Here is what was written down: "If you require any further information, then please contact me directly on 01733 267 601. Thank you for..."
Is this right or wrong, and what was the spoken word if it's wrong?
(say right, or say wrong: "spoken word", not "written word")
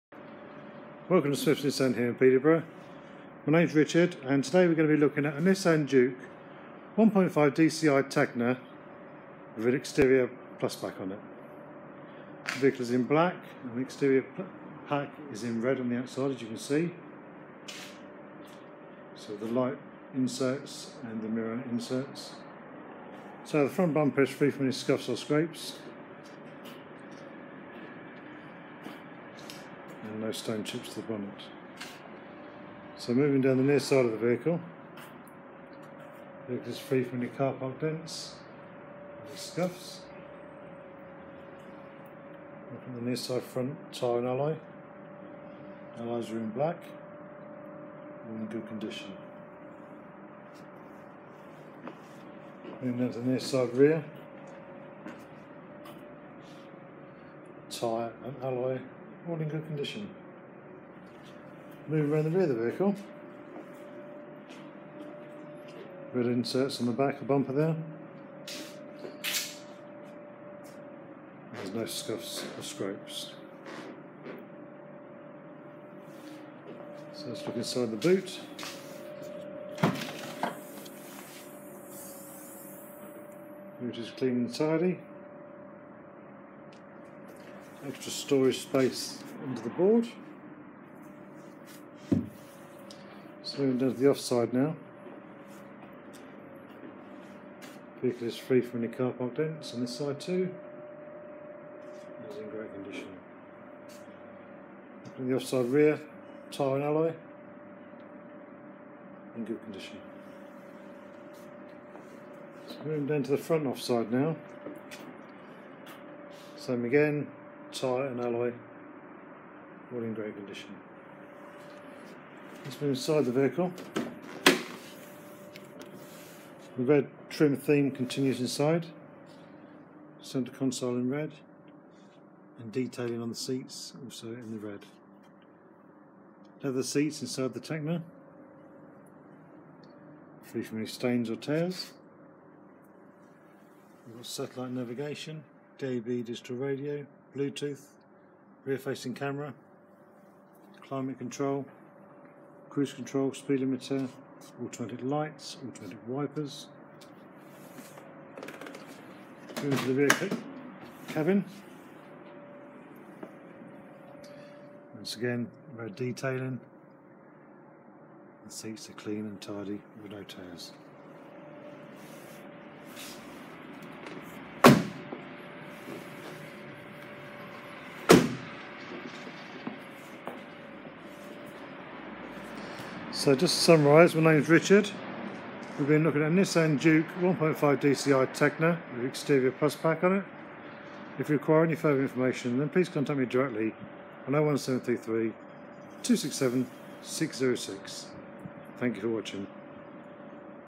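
wrong: "606", not "601".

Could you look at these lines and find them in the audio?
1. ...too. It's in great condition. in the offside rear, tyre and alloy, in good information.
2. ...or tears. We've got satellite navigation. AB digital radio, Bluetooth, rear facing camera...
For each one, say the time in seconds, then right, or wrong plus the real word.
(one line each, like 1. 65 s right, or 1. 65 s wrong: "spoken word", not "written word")
1. 100 s wrong: "condition", not "information"
2. 141 s right.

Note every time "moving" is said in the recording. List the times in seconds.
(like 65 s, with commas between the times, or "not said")
33 s, 52 s, 112 s.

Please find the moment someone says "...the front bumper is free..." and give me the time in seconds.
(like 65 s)
23 s.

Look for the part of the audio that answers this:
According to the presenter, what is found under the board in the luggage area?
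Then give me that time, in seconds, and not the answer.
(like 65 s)
87 s.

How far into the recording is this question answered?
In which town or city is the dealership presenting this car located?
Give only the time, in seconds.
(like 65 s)
2 s.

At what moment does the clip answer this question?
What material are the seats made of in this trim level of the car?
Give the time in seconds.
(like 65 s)
136 s.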